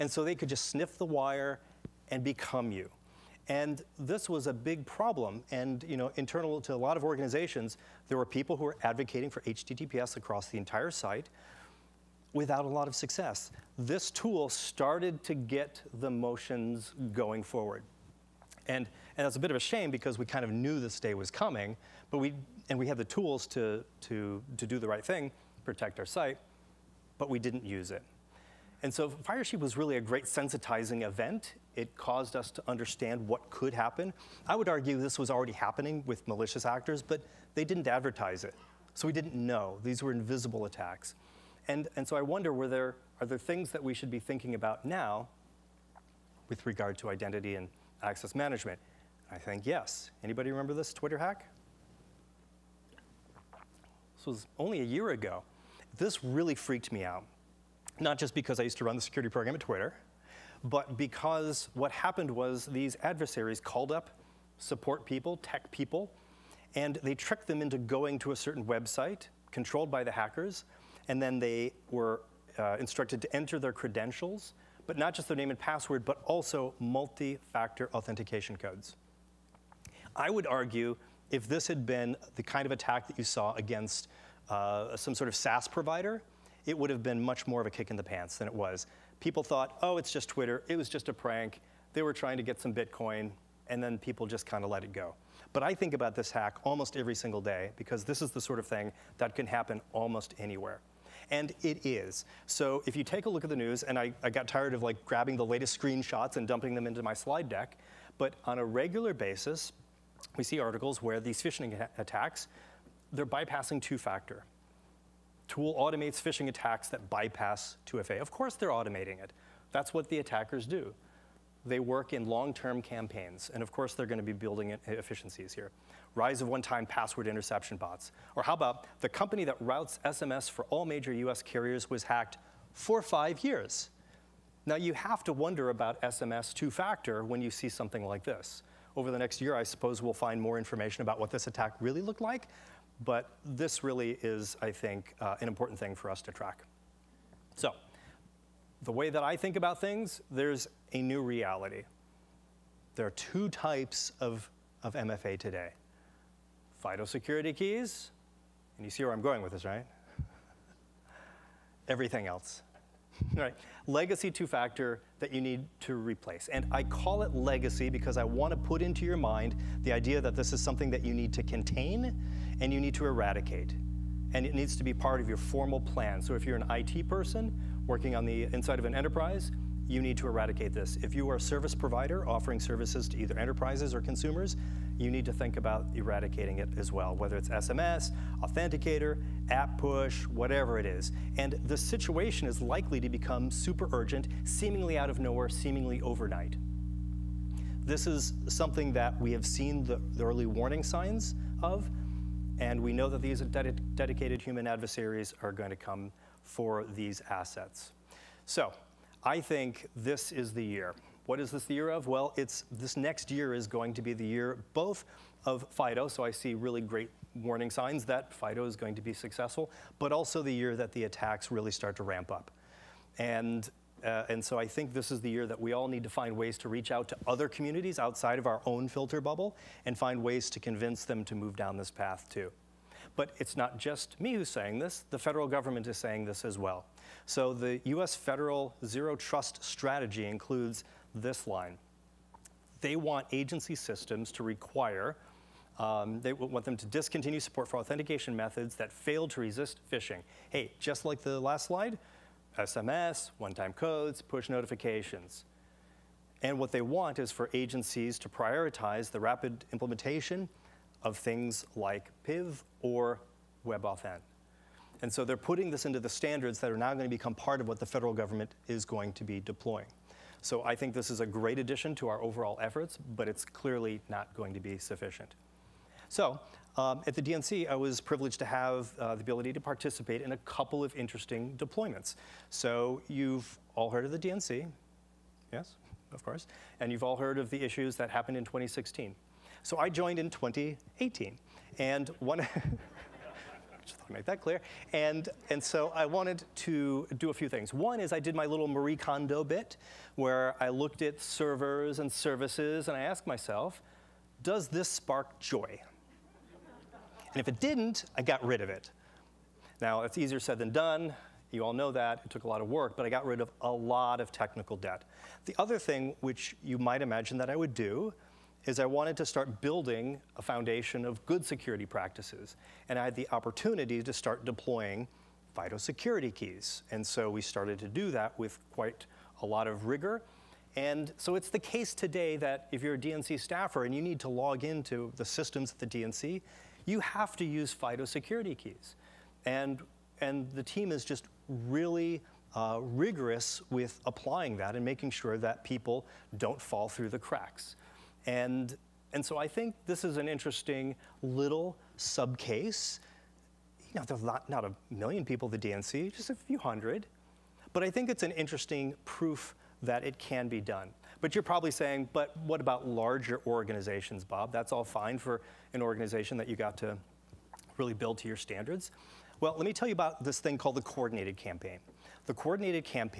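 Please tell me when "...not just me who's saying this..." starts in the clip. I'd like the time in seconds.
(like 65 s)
233 s.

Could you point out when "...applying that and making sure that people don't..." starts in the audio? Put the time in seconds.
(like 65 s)
344 s.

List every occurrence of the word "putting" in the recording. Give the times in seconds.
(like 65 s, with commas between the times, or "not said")
265 s.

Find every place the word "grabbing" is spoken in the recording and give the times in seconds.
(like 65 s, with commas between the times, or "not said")
105 s.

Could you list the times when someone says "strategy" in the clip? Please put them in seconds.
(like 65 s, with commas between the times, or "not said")
239 s.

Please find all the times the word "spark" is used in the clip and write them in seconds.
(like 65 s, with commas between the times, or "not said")
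304 s.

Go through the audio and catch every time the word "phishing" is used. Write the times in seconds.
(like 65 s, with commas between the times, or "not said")
111 s, 116 s, 249 s.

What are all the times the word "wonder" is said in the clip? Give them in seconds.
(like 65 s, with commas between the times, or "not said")
42 s, 135 s.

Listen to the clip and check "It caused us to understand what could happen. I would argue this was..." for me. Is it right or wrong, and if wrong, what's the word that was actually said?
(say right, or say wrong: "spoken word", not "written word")
right.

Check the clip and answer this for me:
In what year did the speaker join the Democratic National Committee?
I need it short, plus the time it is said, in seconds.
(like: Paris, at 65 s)
2018, at 290 s.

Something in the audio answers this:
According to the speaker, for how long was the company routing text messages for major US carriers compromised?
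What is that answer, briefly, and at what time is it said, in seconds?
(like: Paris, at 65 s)
5 years, at 133 s.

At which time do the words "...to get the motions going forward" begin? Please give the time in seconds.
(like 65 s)
15 s.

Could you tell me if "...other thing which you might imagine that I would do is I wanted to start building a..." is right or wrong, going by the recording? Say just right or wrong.
right.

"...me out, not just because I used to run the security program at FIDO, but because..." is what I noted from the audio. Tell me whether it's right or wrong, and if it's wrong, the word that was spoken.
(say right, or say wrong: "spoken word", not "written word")
wrong: "Twitter", not "FIDO".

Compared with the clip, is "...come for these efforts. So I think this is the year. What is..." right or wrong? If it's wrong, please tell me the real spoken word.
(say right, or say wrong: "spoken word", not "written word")
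wrong: "assets", not "efforts".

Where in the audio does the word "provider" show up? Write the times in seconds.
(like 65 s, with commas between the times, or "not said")
85 s, 181 s.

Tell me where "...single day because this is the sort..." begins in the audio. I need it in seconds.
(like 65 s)
97 s.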